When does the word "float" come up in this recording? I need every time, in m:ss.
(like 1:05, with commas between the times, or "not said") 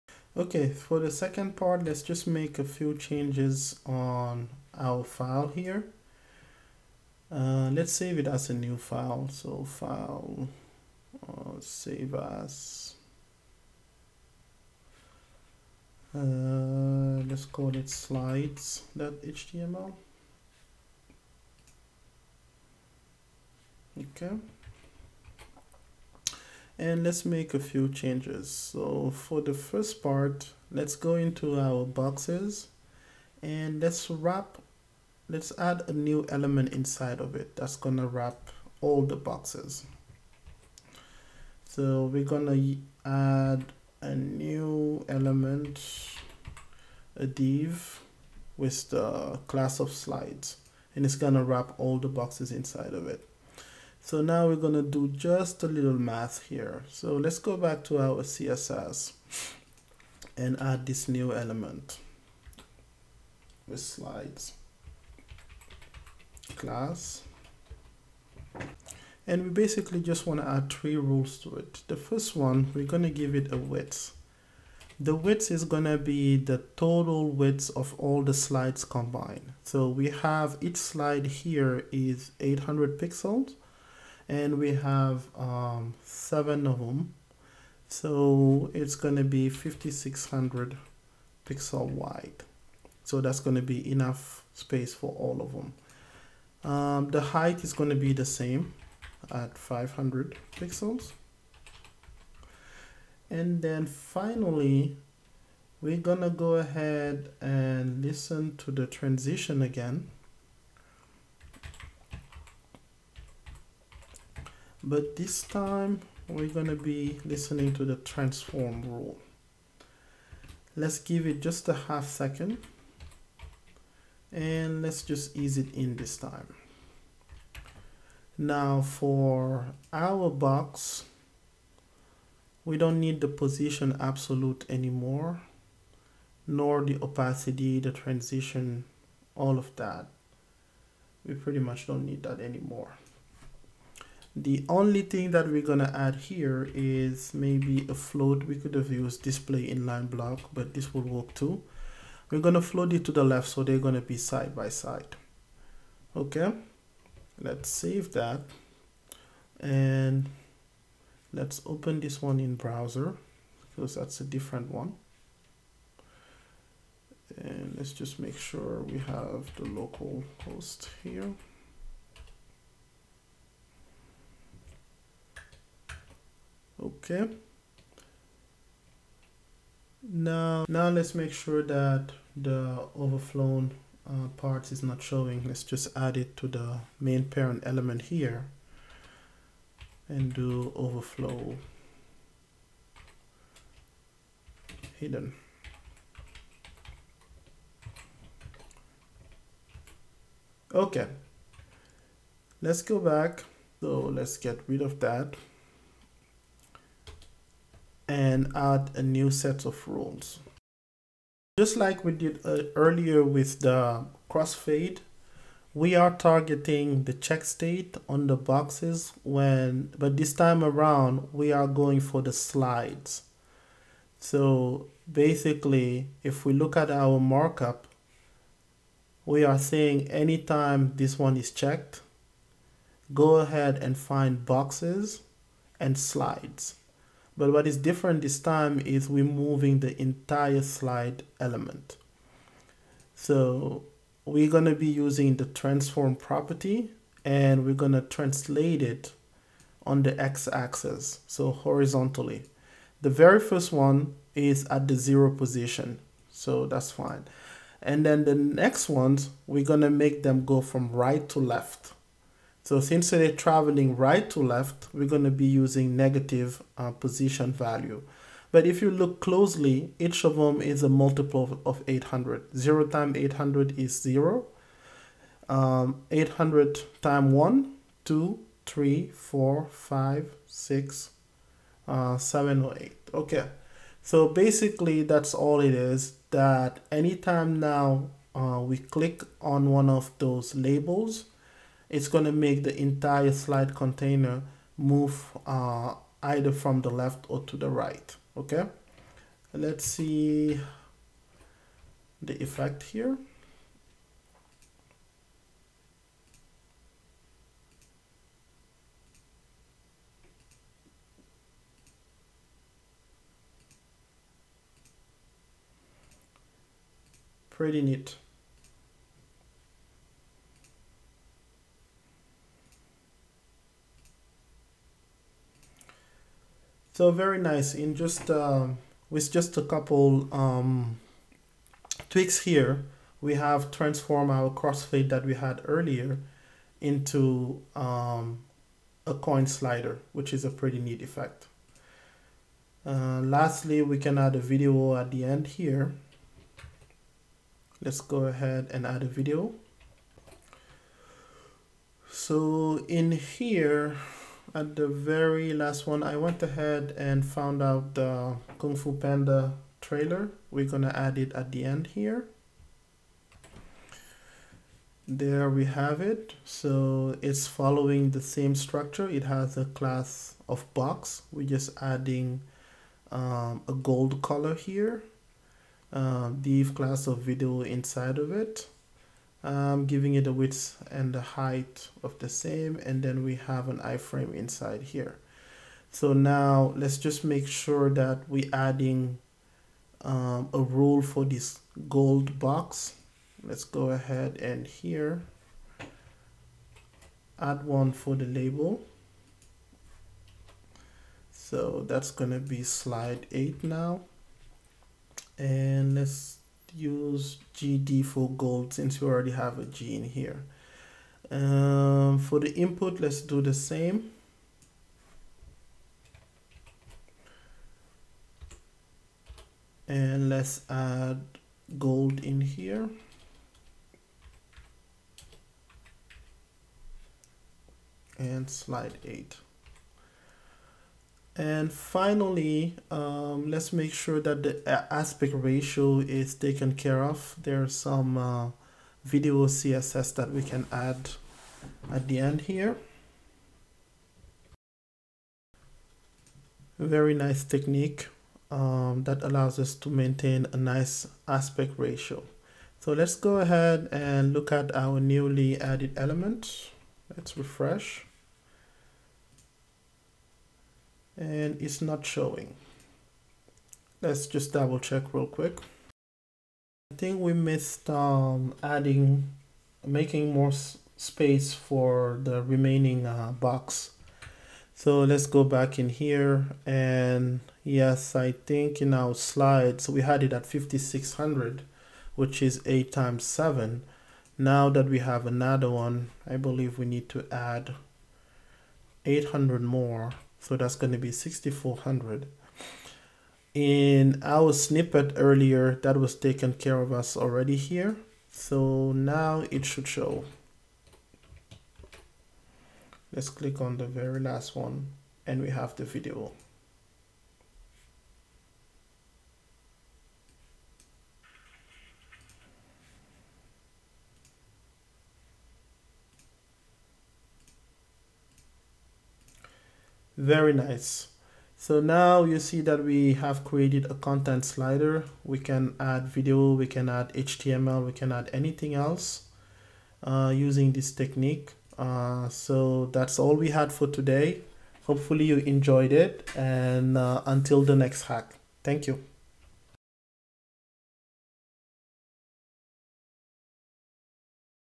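2:27, 2:32.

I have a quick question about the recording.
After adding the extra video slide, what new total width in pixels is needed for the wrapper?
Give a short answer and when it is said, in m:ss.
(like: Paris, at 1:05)
6400, at 8:11.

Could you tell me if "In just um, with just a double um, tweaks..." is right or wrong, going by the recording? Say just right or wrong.
wrong.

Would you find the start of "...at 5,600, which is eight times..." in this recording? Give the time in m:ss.
8:00.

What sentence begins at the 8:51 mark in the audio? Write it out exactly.
Uh, so that's all we had for today.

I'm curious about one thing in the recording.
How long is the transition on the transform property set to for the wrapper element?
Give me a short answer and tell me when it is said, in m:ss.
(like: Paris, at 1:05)
half second, at 2:01.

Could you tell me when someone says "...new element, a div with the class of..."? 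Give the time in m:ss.
0:44.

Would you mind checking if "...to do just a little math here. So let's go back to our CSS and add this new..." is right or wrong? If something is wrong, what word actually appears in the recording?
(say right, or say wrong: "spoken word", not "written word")
right.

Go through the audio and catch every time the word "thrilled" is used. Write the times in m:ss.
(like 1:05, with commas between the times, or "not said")
not said.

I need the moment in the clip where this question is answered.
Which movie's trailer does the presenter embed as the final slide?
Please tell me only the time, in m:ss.
5:58.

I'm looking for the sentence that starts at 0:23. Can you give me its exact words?
Okay and let's make a few changes.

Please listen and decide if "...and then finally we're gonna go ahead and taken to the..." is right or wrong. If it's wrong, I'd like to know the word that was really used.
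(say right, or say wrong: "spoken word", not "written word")
wrong: "listen", not "taken".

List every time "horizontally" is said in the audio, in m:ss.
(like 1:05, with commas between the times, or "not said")
4:11.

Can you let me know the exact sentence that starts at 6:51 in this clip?
Um, for the input, let's do the same.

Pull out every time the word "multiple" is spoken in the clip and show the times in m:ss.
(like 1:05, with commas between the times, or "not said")
4:30.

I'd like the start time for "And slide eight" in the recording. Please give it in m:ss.
7:08.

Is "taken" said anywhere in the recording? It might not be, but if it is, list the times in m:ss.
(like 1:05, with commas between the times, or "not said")
7:16, 8:16.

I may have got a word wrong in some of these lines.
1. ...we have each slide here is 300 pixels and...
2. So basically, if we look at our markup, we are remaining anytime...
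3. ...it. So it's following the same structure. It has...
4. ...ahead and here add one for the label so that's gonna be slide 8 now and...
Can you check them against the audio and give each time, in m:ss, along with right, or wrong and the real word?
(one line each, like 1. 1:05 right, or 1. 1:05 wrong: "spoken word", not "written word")
1. 1:19 wrong: "800", not "300"
2. 3:44 wrong: "saying", not "remaining"
3. 6:06 right
4. 6:33 right.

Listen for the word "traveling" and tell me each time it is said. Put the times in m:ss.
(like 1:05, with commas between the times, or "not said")
4:23.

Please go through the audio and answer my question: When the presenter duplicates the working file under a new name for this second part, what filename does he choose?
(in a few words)
slides.html.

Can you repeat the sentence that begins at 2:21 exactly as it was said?
We pretty much don't need that anymore.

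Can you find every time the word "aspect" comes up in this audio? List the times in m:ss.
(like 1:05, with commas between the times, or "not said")
7:14, 7:31.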